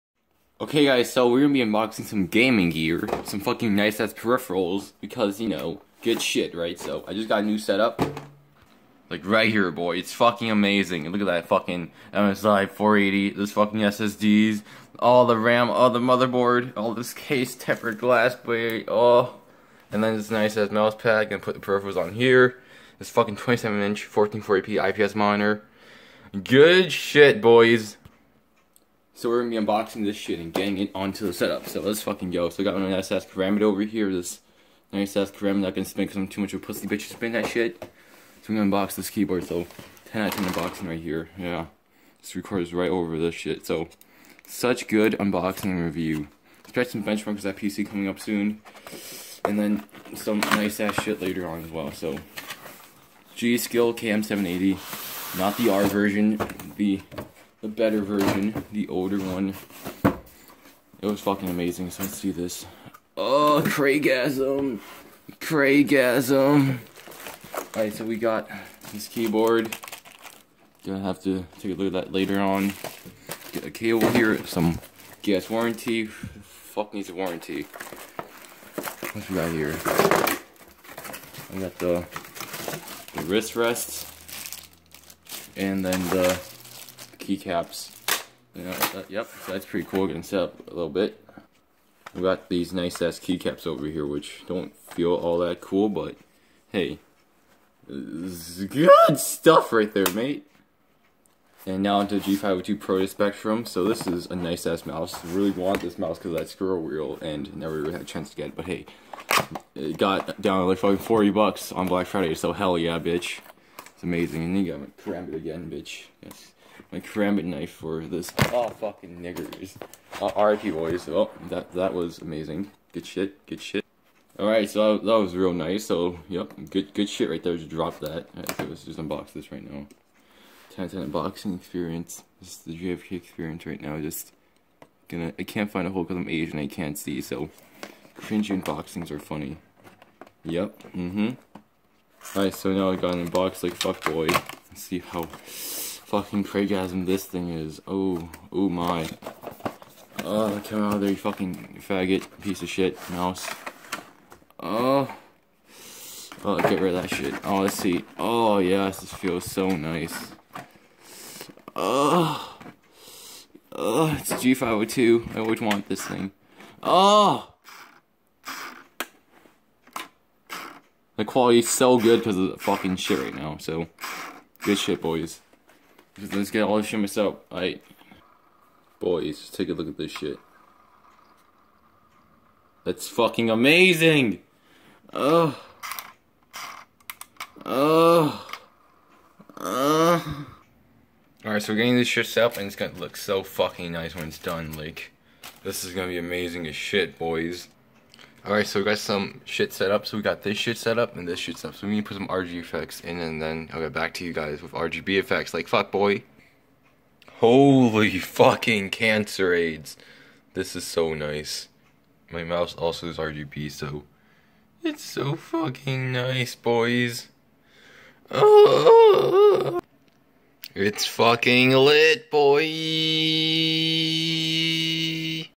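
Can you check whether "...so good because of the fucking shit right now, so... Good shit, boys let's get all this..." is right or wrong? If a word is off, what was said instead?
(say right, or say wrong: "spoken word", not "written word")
right.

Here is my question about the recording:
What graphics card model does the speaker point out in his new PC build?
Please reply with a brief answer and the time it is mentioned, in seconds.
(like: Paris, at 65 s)
MSI 480, at 12 s.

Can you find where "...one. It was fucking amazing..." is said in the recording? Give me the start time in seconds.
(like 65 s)
59 s.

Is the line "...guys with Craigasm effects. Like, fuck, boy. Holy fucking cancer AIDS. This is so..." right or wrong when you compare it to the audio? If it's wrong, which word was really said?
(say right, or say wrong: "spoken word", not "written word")
wrong: "RGB", not "Craigasm".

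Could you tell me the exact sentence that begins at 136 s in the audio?
I can't see, so cringy unboxings are funny.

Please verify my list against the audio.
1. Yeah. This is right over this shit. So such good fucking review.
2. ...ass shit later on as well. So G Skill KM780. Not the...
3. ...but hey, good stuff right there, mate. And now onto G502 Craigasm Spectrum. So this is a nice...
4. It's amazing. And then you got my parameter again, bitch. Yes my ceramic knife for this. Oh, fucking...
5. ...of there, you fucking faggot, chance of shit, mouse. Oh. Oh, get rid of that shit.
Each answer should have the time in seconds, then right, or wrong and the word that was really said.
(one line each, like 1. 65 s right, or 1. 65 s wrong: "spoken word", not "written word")
1. 41 s wrong: "unboxing", not "fucking"
2. 50 s right
3. 95 s wrong: "Pro", not "Craigasm"
4. 113 s right
5. 150 s wrong: "piece", not "chance".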